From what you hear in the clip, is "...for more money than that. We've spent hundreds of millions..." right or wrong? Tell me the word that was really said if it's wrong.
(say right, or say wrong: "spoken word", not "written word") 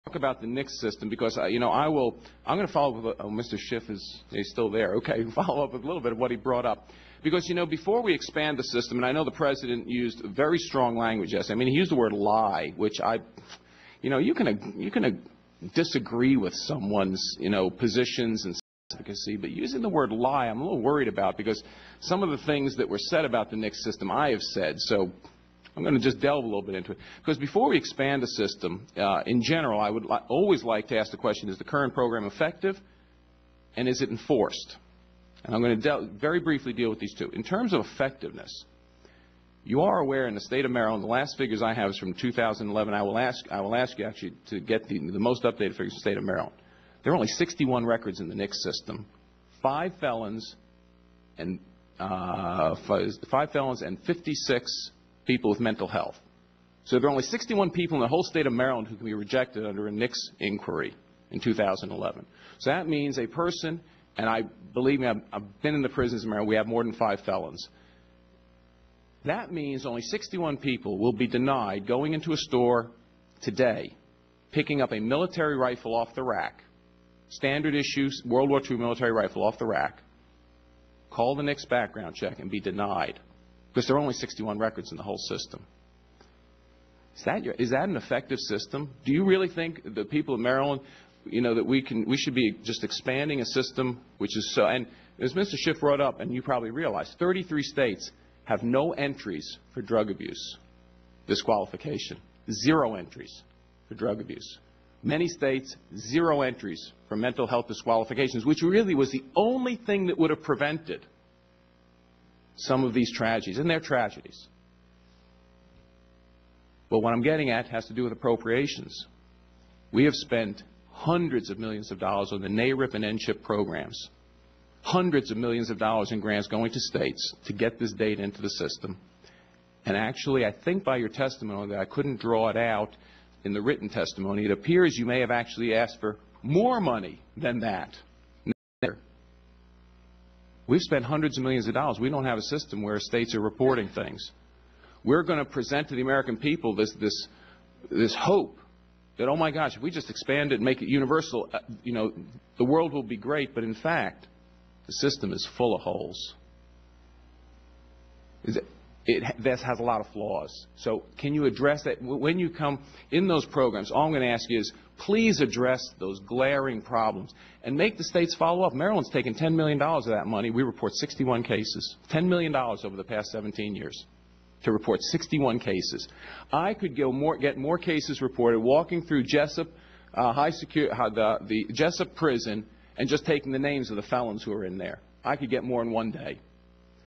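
right.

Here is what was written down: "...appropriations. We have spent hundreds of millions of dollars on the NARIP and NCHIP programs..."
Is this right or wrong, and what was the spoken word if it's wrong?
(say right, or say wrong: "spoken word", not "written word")
right.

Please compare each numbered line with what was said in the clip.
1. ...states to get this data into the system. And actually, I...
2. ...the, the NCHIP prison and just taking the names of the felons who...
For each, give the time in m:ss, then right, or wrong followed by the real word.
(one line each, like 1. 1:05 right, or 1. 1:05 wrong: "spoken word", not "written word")
1. 2:06 right
2. 3:01 wrong: "Jessup", not "NCHIP".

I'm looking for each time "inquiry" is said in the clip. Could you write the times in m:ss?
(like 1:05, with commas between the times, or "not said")
1:00.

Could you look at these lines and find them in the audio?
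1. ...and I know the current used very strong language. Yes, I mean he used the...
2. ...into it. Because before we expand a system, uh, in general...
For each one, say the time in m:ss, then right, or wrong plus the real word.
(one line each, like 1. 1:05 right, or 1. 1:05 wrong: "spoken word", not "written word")
1. 0:08 wrong: "president", not "current"
2. 0:26 right.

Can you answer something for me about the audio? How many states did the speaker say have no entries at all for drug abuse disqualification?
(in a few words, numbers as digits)
33.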